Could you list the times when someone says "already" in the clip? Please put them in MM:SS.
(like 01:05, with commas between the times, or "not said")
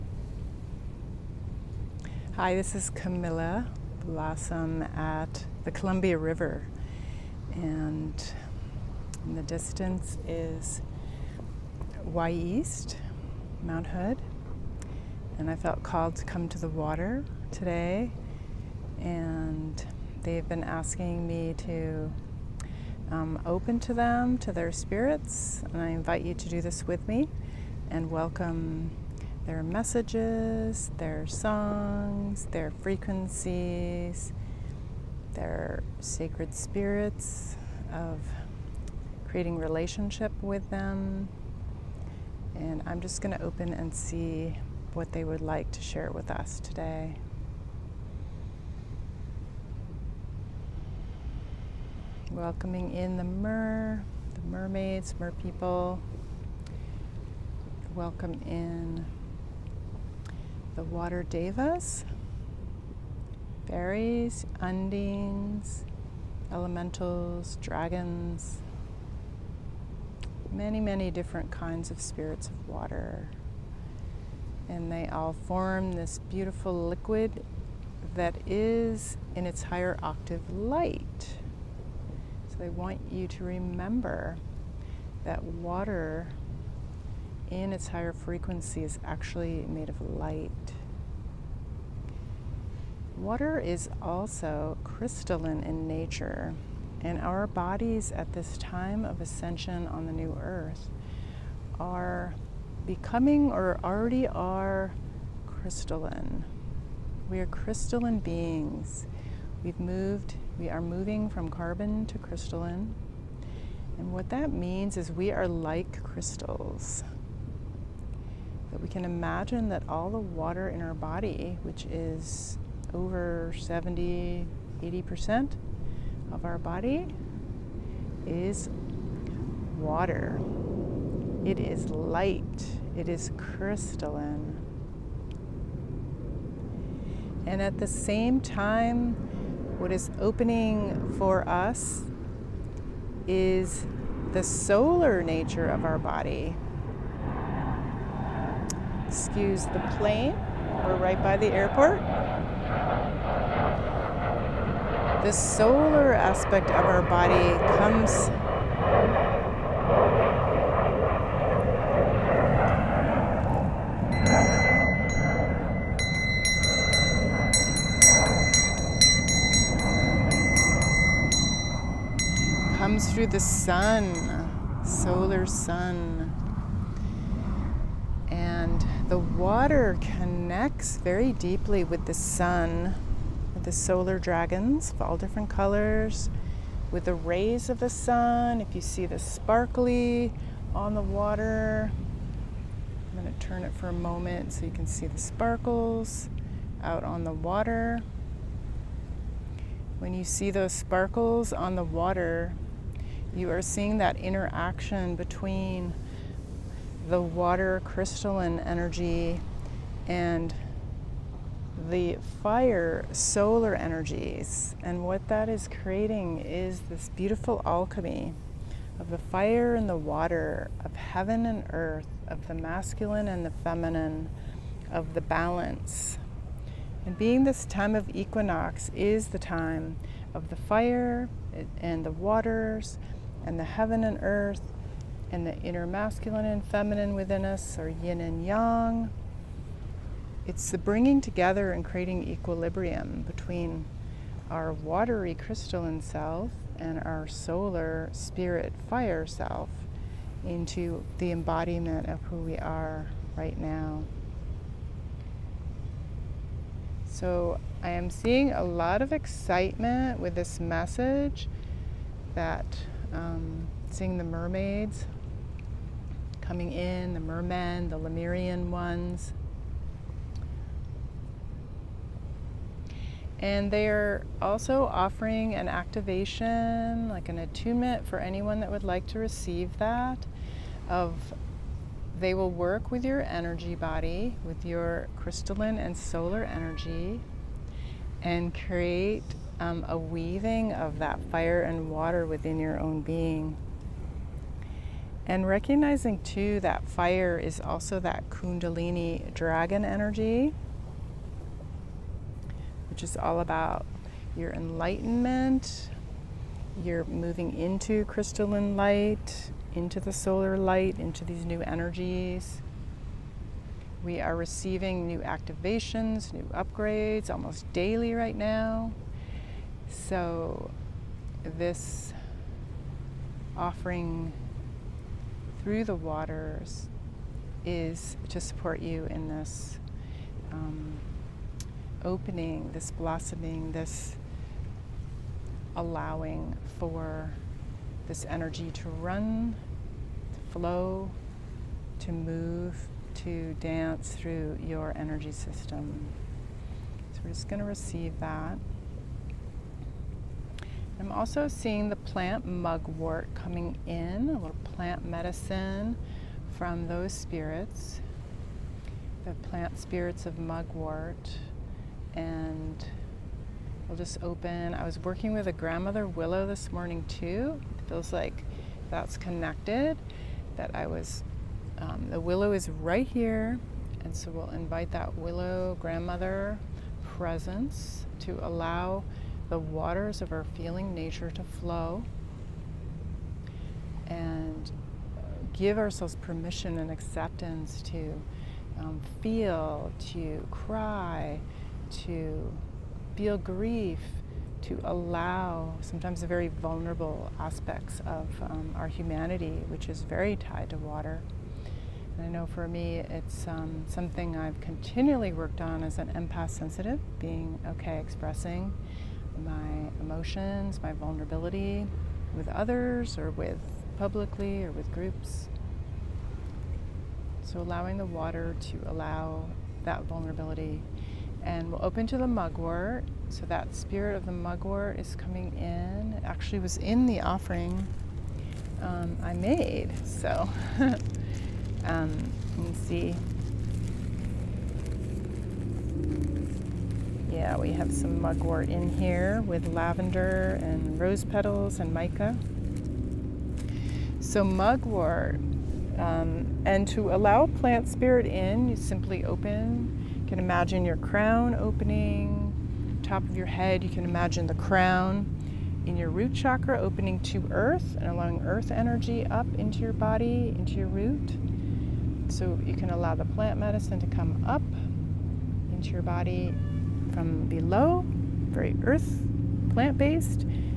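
01:43.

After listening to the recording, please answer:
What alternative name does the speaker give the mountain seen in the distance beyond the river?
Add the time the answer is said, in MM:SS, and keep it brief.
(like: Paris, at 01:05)
Wy'east, at 00:12.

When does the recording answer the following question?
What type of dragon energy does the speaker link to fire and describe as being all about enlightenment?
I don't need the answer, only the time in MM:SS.
04:58.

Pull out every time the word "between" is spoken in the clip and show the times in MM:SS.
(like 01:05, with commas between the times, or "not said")
03:25, 04:03.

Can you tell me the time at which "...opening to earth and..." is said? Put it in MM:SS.
07:36.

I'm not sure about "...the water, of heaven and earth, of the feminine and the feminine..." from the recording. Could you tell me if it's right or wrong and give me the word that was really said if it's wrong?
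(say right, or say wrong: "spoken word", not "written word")
wrong: "masculine", not "feminine".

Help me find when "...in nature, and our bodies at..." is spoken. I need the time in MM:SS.
01:35.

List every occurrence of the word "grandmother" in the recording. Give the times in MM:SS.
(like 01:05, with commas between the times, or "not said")
06:05, 06:15.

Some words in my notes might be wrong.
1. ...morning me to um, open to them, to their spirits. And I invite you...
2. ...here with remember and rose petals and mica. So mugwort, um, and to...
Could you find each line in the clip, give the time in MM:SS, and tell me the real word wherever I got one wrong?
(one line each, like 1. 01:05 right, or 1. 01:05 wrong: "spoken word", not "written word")
1. 00:20 wrong: "asking", not "morning"
2. 07:18 wrong: "lavender", not "remember".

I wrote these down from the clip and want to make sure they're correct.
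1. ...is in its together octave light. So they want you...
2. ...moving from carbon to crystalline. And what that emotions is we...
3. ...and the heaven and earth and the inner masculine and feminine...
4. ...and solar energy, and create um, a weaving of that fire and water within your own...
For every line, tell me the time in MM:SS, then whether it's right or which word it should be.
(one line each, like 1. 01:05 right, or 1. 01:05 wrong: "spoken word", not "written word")
1. 01:18 wrong: "higher", not "together"
2. 01:50 wrong: "means", not "emotions"
3. 03:53 right
4. 04:45 right.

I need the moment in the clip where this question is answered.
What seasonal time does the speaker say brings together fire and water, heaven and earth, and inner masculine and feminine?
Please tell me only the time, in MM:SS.
03:48.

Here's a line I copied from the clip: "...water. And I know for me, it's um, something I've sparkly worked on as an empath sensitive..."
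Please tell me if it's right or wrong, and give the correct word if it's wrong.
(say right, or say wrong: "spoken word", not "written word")
wrong: "continually", not "sparkly".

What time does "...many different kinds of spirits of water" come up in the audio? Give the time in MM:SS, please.
01:10.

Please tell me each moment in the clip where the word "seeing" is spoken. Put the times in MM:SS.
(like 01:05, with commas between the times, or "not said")
03:23, 04:18, 04:23, 05:51.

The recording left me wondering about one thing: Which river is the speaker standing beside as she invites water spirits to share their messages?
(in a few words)
Columbia River.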